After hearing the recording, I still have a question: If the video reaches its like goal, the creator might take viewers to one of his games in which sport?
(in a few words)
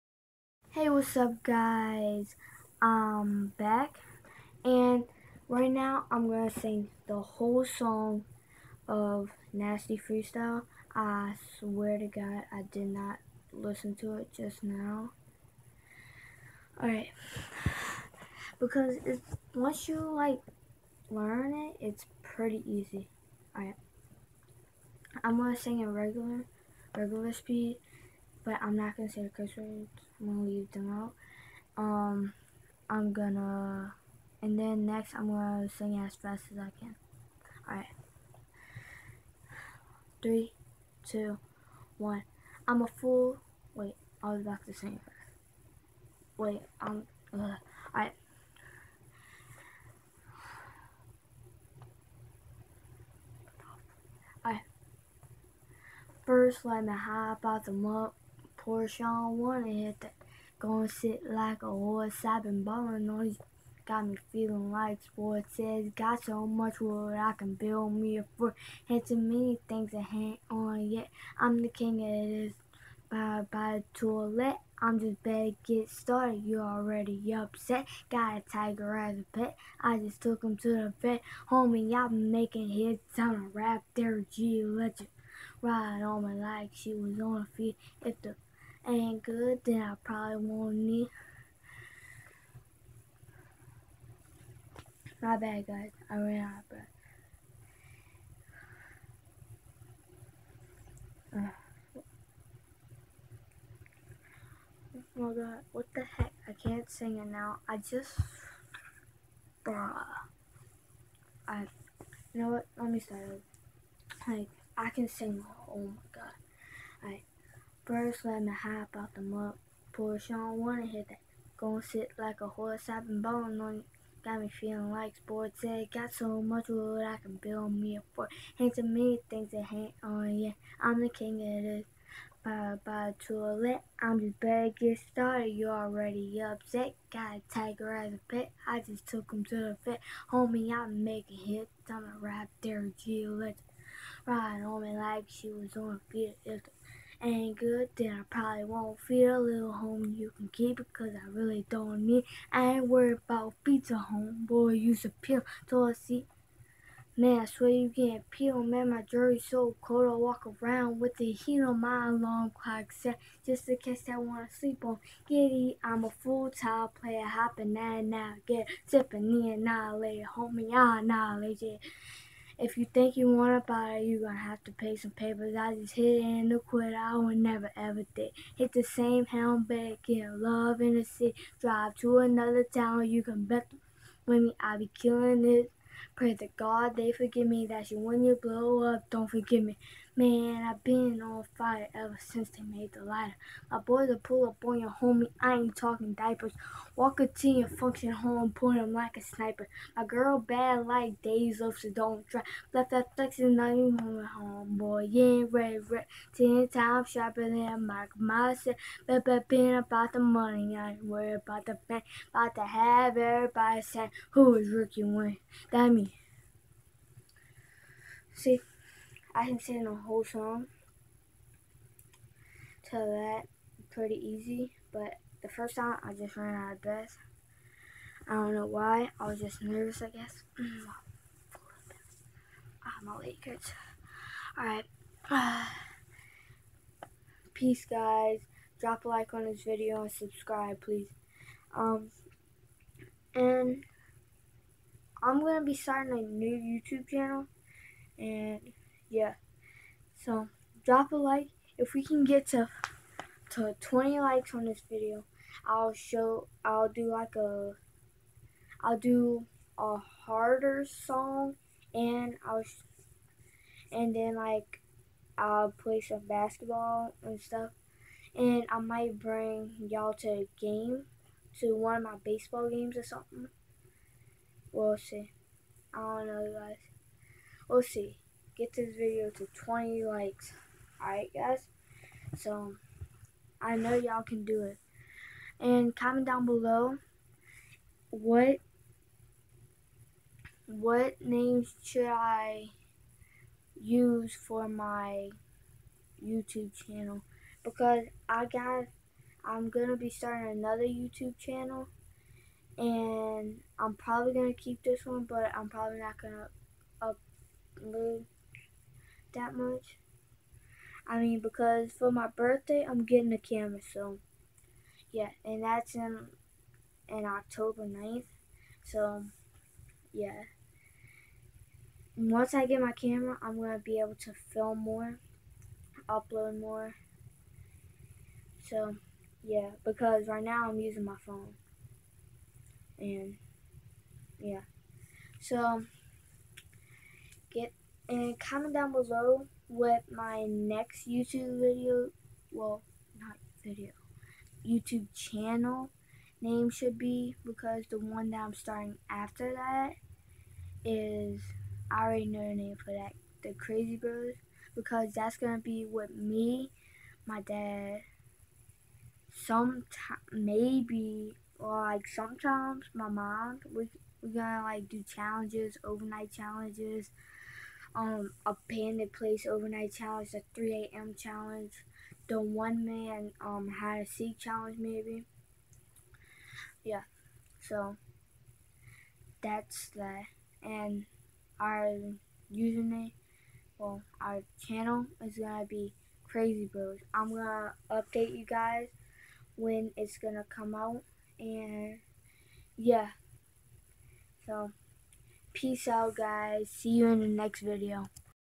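baseball.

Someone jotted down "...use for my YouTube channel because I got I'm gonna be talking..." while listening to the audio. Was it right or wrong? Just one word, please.
wrong.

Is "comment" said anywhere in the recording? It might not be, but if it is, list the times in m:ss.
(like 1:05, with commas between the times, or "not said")
4:45, 5:38.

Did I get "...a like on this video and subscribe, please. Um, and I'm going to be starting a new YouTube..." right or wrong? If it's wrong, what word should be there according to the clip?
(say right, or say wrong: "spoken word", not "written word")
right.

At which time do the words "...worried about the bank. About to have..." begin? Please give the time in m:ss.
3:31.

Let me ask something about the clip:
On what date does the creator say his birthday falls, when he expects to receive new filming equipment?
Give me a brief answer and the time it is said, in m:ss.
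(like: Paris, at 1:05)
October 9th, at 5:17.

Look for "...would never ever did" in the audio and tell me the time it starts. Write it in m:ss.
2:57.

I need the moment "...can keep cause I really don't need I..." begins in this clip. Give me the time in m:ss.
2:30.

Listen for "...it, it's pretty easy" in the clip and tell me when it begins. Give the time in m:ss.
0:21.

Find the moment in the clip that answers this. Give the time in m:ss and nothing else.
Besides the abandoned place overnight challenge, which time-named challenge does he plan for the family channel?
6:10.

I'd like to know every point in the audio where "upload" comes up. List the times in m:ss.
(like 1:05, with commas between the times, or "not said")
5:07, 5:26.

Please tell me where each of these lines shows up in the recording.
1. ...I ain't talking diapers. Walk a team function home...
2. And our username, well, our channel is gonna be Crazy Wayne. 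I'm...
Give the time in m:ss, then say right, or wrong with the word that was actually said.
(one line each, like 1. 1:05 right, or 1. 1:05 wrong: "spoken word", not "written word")
1. 3:15 right
2. 6:20 wrong: "Bros", not "Wayne".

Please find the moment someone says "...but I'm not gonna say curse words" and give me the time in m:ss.
0:28.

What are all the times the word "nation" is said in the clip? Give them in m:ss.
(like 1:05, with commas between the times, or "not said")
not said.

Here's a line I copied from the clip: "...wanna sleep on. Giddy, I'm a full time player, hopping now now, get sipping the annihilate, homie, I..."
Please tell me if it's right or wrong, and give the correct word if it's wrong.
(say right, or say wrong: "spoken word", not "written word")
right.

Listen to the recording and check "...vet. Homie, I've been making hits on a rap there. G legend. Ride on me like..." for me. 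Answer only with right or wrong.
right.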